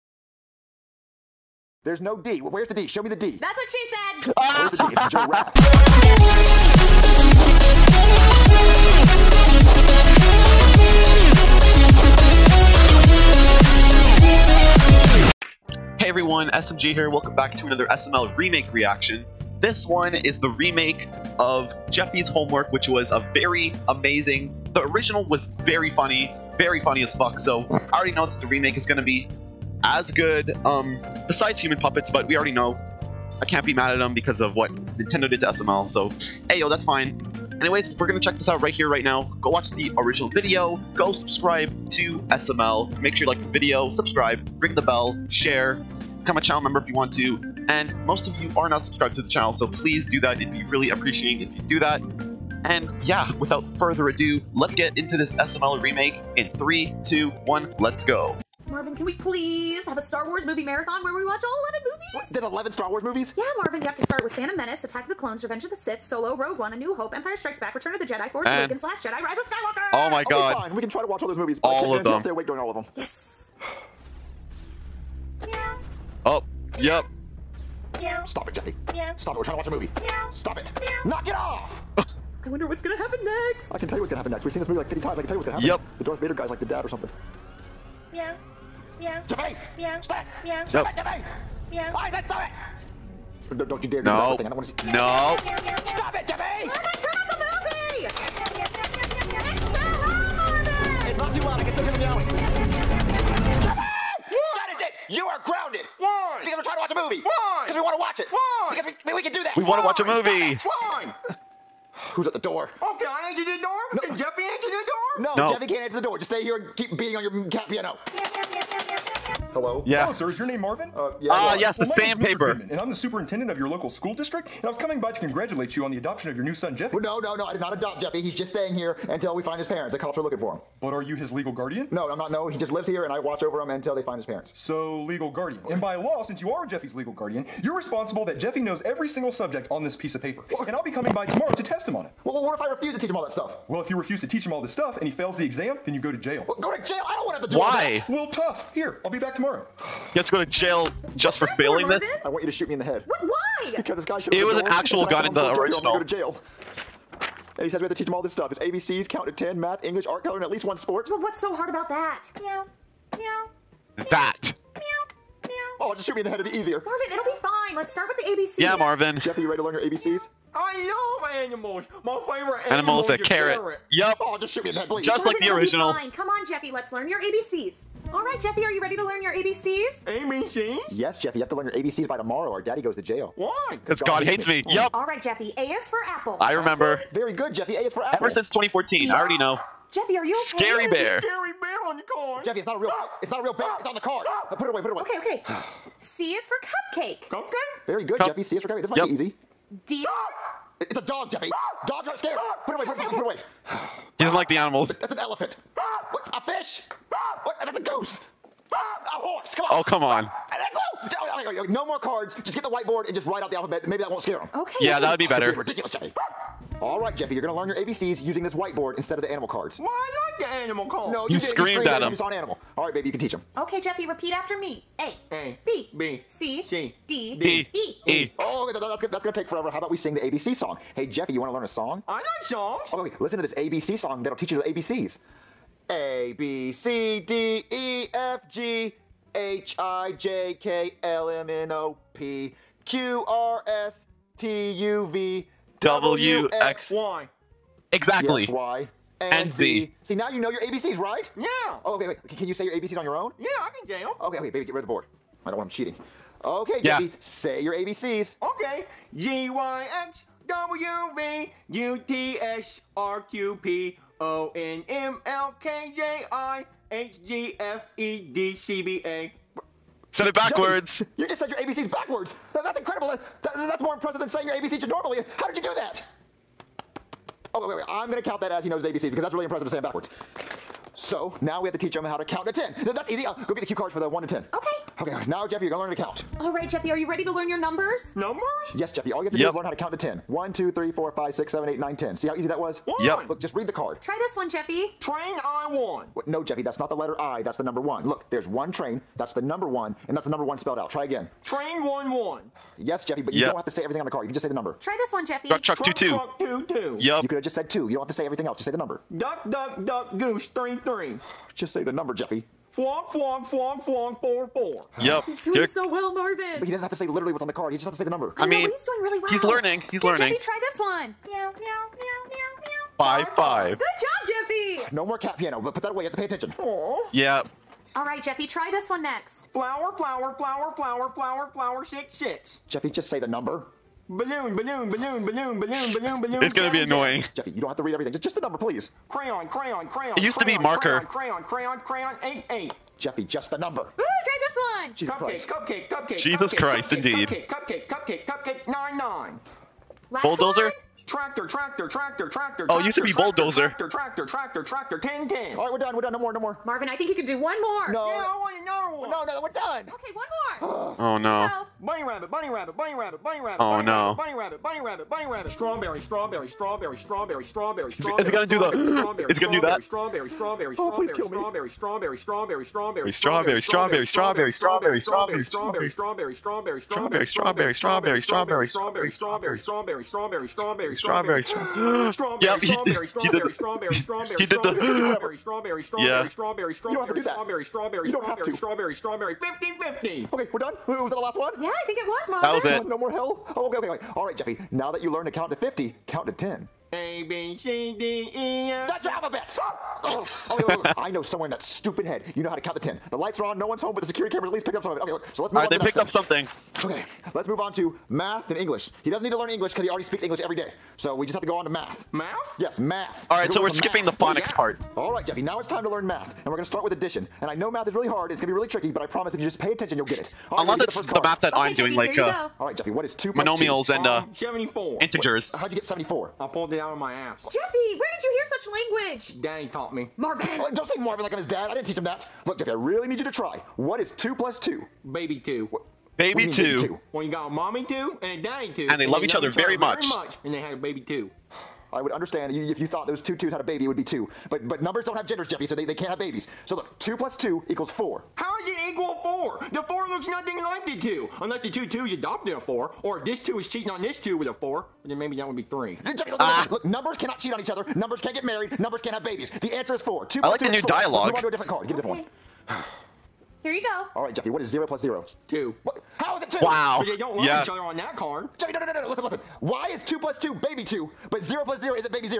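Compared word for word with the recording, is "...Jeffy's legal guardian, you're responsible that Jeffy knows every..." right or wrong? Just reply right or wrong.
right.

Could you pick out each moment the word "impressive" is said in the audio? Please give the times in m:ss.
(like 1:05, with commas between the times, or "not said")
4:33, 4:39.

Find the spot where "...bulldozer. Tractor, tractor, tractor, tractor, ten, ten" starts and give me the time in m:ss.
5:53.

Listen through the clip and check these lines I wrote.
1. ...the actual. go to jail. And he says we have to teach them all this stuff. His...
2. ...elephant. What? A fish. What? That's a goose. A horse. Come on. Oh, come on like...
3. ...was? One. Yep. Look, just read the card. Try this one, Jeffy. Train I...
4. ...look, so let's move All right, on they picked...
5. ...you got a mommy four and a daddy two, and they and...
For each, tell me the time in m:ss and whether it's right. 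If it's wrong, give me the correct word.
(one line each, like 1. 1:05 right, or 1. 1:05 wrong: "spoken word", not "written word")
1. 2:35 wrong: "original", not "actual"
2. 3:25 right
3. 4:52 right
4. 6:45 right
5. 7:17 wrong: "two", not "four".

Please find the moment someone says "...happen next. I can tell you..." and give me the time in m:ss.
1:22.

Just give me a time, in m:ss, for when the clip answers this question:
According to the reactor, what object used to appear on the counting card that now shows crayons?
5:40.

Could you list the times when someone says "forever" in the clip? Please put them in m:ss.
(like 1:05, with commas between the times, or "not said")
3:49.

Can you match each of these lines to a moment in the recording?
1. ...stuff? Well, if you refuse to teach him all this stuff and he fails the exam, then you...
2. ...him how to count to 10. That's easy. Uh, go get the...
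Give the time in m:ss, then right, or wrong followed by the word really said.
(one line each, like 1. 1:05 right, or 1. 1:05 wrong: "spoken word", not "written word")
1. 2:23 right
2. 4:41 right.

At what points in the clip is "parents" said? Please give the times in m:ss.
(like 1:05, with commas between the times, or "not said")
2:09, 2:14.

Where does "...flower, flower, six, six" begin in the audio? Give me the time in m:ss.
5:31.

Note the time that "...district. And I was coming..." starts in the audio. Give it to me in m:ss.
2:04.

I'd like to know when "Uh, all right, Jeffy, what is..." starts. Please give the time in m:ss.
7:02.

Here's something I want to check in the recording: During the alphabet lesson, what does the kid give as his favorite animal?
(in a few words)
A carrot.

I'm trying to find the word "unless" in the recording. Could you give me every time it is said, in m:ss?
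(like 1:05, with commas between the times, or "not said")
7:00, 7:31.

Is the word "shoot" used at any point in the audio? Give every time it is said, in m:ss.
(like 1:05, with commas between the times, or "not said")
2:32, 2:46, 2:54.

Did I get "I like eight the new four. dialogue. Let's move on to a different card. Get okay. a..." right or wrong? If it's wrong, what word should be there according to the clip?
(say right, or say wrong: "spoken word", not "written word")
wrong: "two", not "eight".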